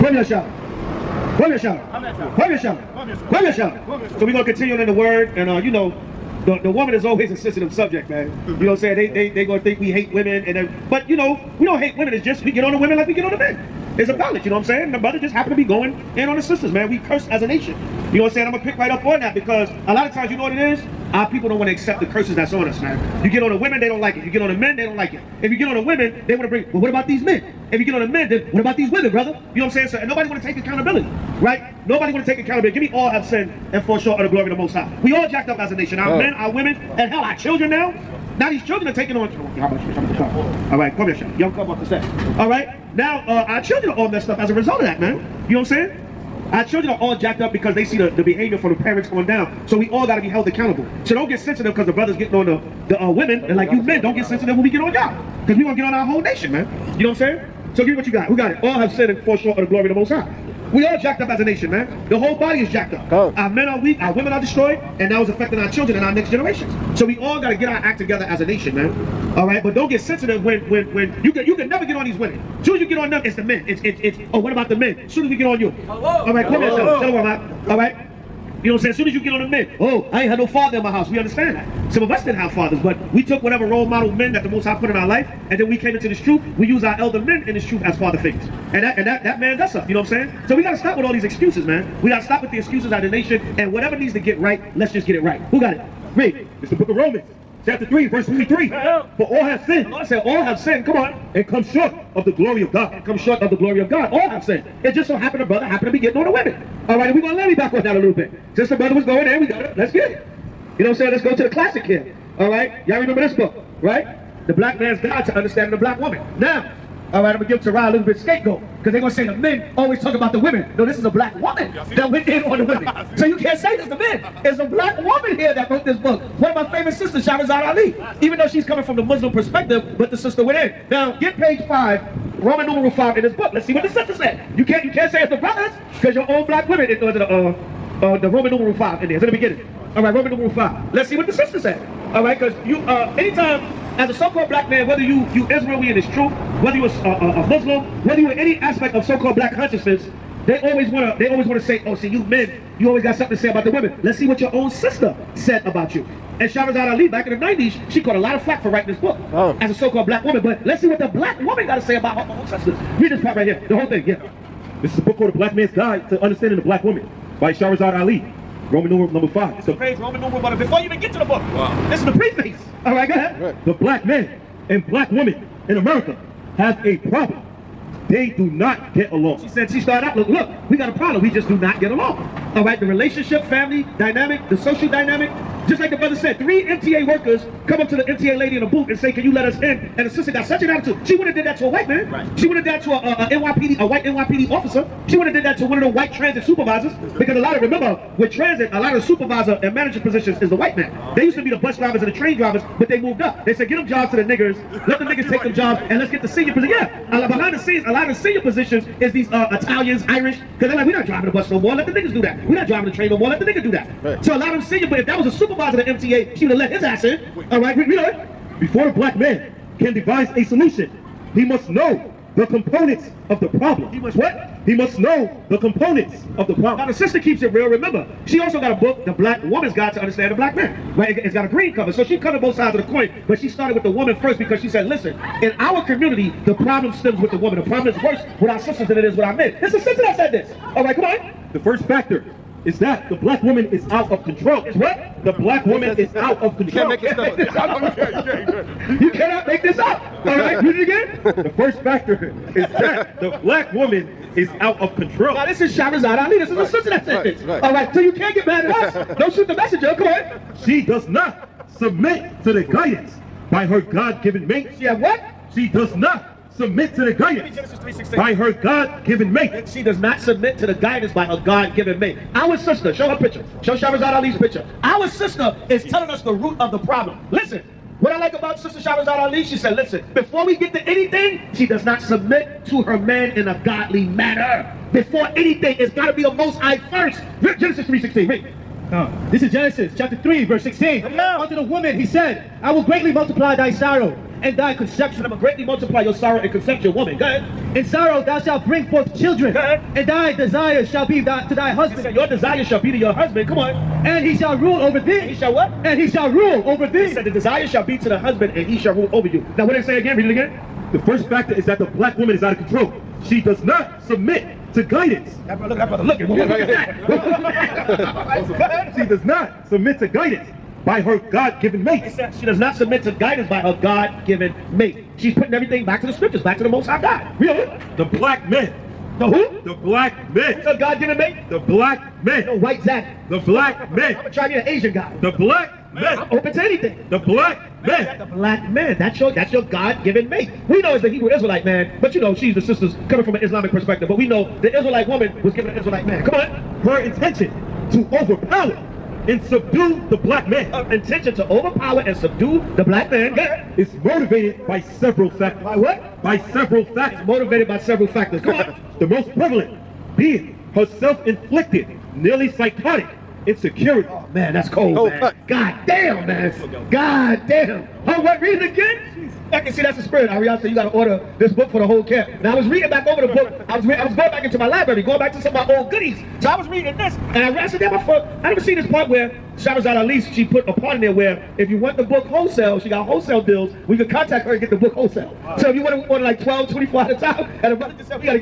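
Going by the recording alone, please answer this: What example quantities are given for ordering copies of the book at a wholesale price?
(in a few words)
12, 24.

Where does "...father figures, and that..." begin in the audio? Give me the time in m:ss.
1:27.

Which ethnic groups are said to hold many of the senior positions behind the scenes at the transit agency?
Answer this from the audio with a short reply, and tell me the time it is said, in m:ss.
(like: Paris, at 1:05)
Italians, Irish, at 3:29.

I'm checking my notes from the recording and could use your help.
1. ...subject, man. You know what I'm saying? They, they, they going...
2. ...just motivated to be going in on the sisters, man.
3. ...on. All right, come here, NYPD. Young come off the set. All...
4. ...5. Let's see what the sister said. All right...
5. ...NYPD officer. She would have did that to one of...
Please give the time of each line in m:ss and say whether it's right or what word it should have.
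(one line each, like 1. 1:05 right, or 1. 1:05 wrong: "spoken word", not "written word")
1. 0:07 right
2. 0:15 wrong: "happened", not "motivated"
3. 0:39 wrong: "Shelly", not "NYPD"
4. 2:20 right
5. 3:14 right.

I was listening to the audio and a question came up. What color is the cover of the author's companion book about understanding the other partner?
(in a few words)
Green.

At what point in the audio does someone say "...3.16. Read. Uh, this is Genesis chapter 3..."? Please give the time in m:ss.
4:47.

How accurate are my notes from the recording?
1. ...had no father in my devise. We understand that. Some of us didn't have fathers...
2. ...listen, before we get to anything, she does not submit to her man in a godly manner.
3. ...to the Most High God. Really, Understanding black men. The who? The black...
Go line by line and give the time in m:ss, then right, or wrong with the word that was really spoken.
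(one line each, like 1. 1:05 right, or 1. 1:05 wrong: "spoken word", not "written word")
1. 1:20 wrong: "house", not "devise"
2. 4:39 right
3. 5:26 wrong: "The", not "Understanding".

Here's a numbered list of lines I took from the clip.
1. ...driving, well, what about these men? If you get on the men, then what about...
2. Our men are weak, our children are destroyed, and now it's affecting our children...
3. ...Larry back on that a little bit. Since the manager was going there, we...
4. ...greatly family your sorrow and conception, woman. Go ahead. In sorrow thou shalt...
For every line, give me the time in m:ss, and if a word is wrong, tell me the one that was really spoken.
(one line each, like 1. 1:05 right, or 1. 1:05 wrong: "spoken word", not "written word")
1. 0:26 wrong: "bring", not "driving"
2. 1:03 wrong: "women", not "children"
3. 1:47 wrong: "brother", not "manager"
4. 4:55 wrong: "multiply", not "family".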